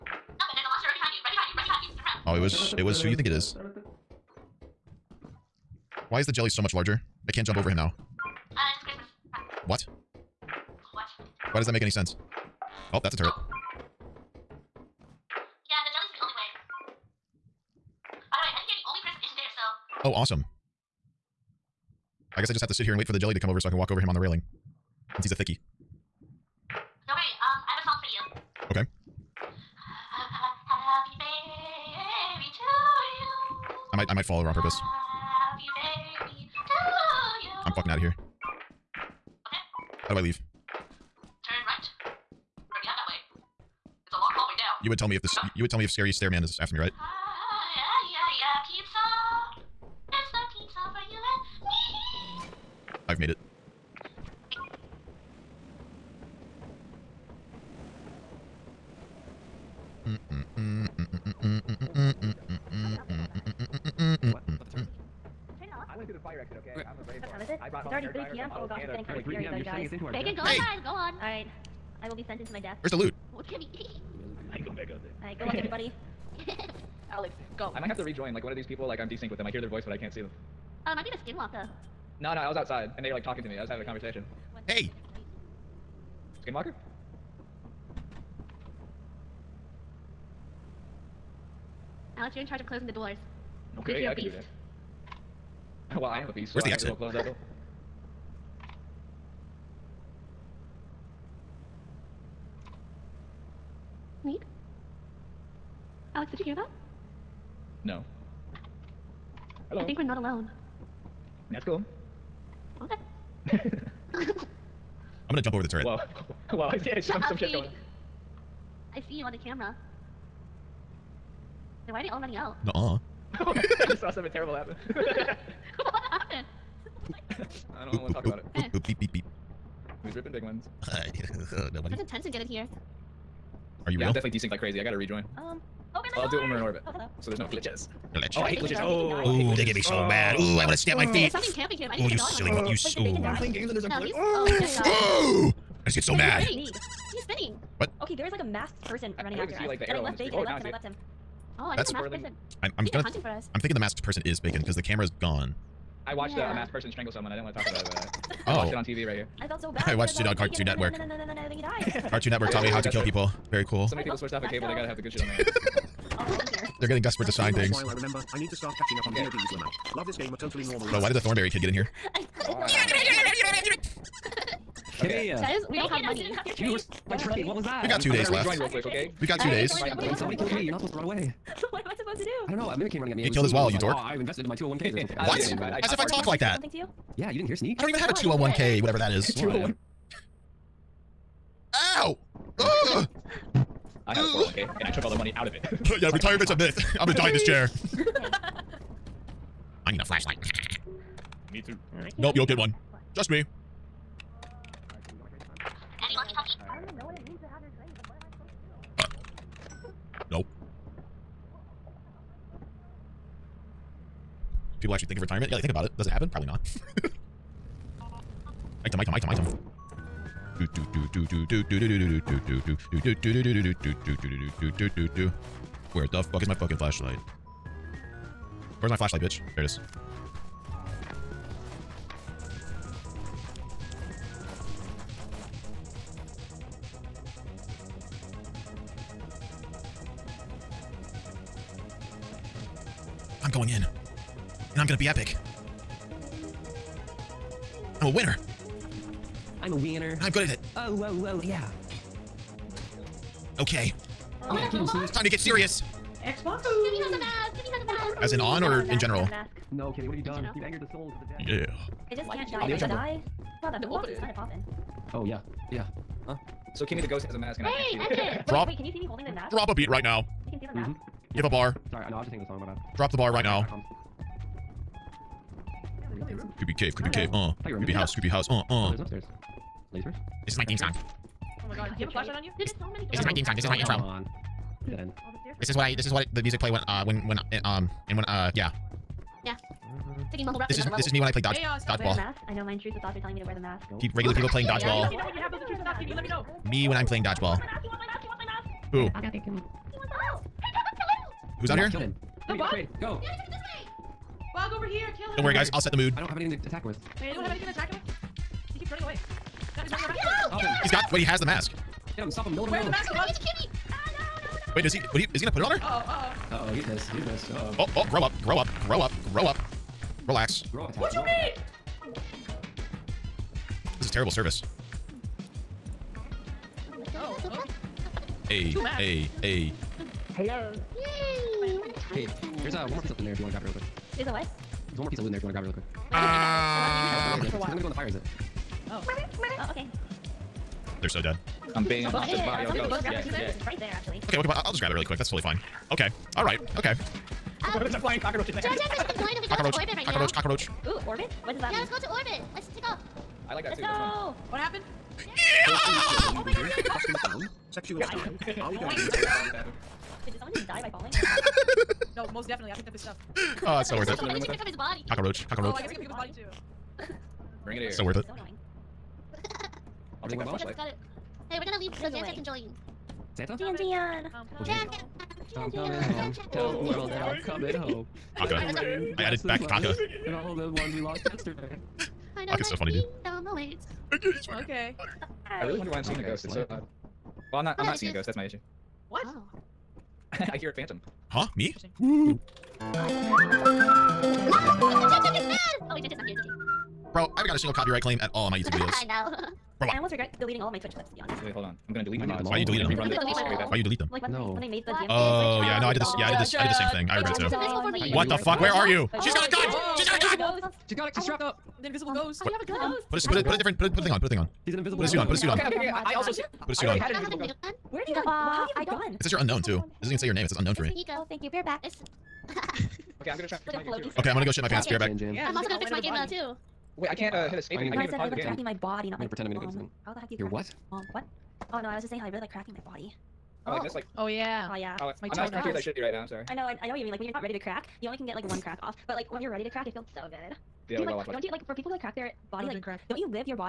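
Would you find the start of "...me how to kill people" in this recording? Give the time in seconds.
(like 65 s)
162 s.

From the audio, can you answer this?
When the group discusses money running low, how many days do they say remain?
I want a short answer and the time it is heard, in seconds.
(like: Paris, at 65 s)
2, at 179 s.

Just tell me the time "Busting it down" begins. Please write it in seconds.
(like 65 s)
356 s.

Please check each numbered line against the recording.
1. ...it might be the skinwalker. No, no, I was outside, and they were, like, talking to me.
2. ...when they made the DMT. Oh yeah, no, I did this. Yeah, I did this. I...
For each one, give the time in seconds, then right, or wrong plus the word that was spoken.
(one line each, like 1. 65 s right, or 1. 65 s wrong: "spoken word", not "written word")
1. 80 s right
2. 404 s right.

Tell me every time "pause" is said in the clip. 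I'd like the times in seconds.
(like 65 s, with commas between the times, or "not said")
428 s.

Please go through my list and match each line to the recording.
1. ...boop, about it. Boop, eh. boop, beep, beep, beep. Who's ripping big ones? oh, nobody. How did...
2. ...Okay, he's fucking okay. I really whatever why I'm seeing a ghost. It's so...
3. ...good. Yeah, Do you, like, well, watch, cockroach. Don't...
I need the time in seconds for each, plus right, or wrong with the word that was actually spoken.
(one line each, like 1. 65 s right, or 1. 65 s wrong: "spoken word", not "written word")
1. 128 s right
2. 384 s wrong: "wonder", not "whatever"
3. 440 s wrong: "watch", not "cockroach".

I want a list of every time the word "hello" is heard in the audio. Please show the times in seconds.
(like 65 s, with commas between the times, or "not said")
109 s, 136 s.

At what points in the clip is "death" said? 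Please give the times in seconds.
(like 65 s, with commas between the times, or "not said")
72 s.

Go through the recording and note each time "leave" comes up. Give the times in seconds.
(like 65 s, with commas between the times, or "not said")
40 s, 371 s.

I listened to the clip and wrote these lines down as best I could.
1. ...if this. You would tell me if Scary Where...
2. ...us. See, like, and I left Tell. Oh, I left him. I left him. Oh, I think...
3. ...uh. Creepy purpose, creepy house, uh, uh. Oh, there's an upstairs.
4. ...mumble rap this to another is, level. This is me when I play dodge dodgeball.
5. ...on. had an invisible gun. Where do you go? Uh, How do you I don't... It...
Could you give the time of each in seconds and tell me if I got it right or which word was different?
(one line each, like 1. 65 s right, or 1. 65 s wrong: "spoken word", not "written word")
1. 45 s wrong: "Stairman", not "Where"
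2. 149 s wrong: "Bacon", not "Tell"
3. 277 s wrong: "house", not "purpose"
4. 290 s right
5. 416 s right.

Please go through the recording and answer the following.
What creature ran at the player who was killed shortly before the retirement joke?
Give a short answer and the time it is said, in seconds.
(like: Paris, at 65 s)
mimic, at 182 s.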